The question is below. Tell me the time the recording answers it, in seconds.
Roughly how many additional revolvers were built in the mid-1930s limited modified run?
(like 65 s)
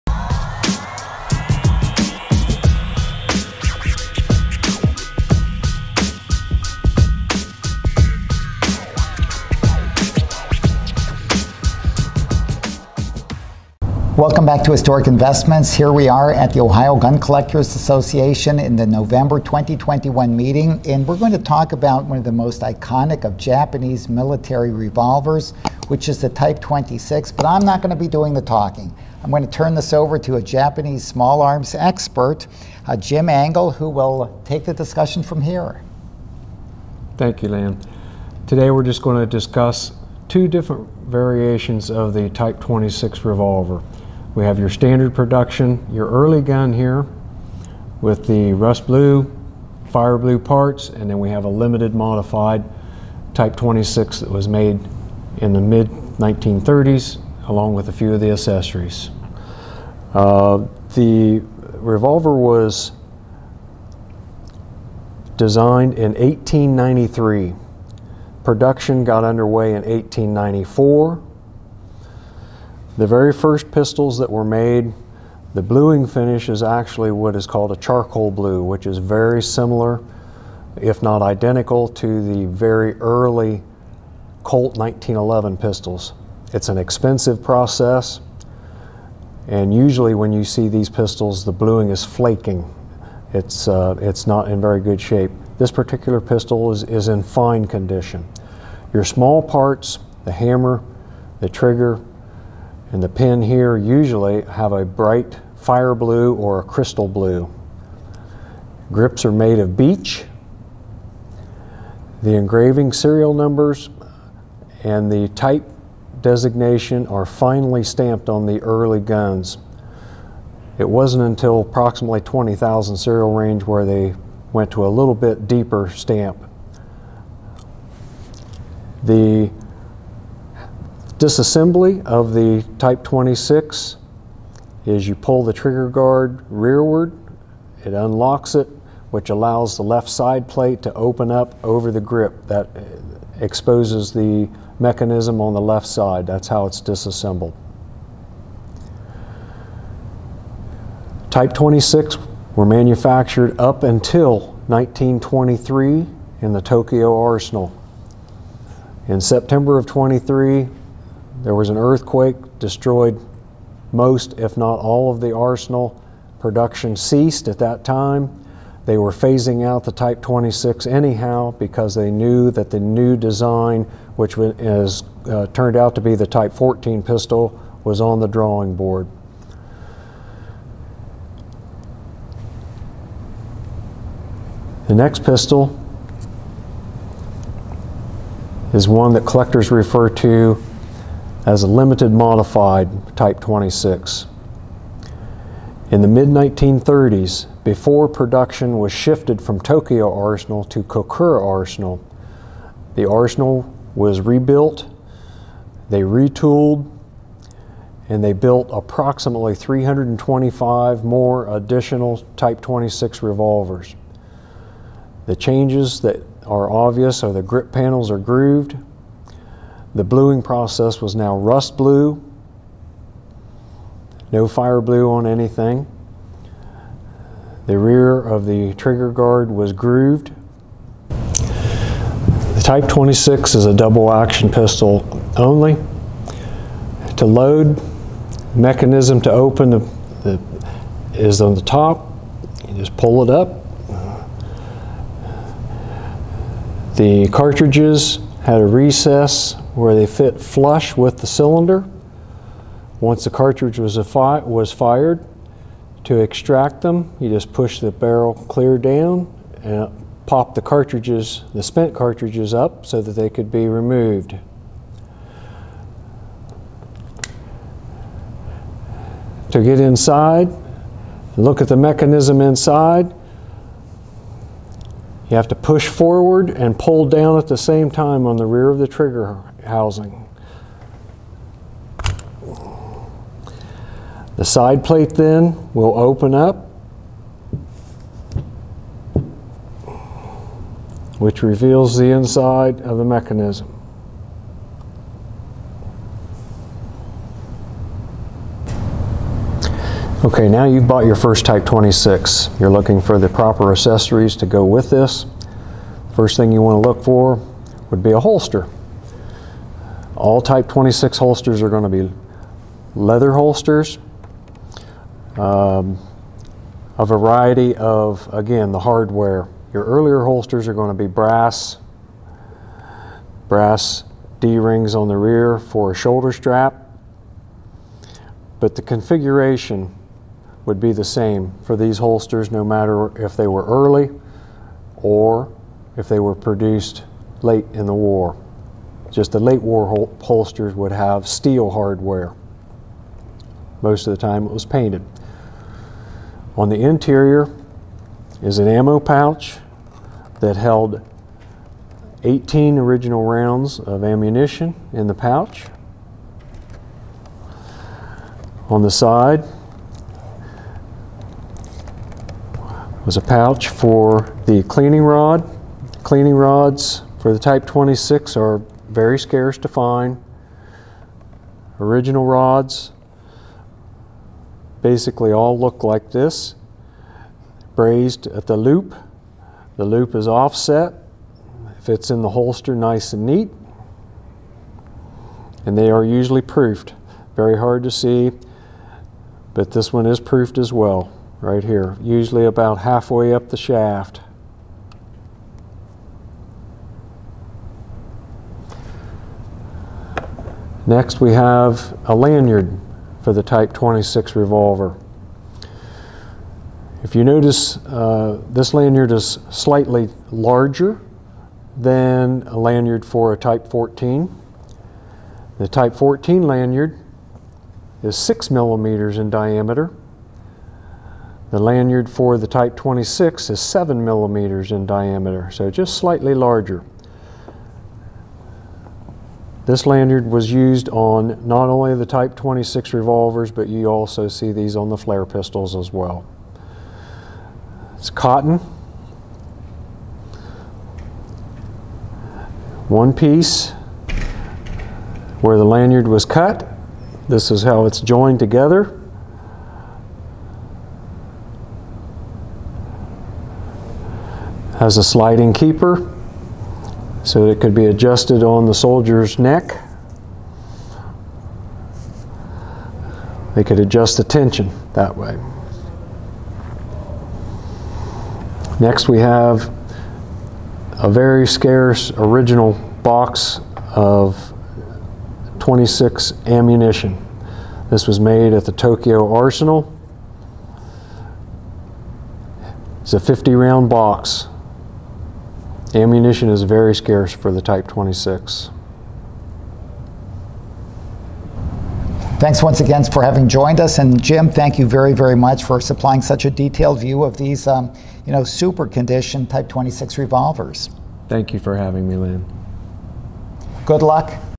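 209 s.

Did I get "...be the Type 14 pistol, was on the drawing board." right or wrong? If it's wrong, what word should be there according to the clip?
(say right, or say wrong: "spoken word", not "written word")
right.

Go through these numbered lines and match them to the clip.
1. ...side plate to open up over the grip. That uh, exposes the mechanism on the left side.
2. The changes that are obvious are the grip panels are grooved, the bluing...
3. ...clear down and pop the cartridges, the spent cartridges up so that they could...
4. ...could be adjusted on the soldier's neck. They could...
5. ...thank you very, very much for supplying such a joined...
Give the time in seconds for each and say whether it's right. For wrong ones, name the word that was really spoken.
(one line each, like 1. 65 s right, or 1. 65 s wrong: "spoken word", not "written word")
1. 140 s right
2. 215 s right
3. 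258 s right
4. 457 s right
5. 494 s wrong: "detailed", not "joined".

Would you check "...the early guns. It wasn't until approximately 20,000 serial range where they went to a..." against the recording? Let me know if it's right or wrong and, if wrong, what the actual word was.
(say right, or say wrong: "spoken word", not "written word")
right.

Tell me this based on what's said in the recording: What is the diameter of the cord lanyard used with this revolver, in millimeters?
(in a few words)
7 millimeters.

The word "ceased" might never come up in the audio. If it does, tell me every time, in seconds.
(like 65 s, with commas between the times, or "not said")
166 s.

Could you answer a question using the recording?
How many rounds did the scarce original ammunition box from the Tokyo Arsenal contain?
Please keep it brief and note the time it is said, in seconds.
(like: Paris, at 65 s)
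50, at 483 s.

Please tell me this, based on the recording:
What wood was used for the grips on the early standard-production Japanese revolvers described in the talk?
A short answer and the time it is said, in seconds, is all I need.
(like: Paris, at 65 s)
Beech, at 109 s.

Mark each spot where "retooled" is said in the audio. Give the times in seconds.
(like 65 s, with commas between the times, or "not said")
206 s.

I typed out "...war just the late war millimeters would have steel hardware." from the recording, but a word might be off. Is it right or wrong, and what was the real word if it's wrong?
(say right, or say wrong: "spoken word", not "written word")
wrong: "holsters", not "millimeters".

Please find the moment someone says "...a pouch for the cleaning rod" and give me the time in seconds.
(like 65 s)
363 s.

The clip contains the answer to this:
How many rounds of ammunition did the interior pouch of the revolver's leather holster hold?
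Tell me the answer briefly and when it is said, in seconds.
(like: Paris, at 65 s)
18, at 352 s.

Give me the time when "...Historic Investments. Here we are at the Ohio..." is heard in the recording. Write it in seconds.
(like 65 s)
14 s.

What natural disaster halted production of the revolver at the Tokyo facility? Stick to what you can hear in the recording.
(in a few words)
An earthquake.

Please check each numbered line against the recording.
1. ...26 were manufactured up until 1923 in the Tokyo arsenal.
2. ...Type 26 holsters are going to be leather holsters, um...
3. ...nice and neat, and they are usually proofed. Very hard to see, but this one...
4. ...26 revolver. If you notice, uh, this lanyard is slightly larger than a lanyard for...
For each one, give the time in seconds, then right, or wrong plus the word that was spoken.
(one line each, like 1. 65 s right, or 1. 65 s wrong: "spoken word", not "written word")
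1. 151 s right
2. 310 s right
3. 382 s right
4. 403 s right.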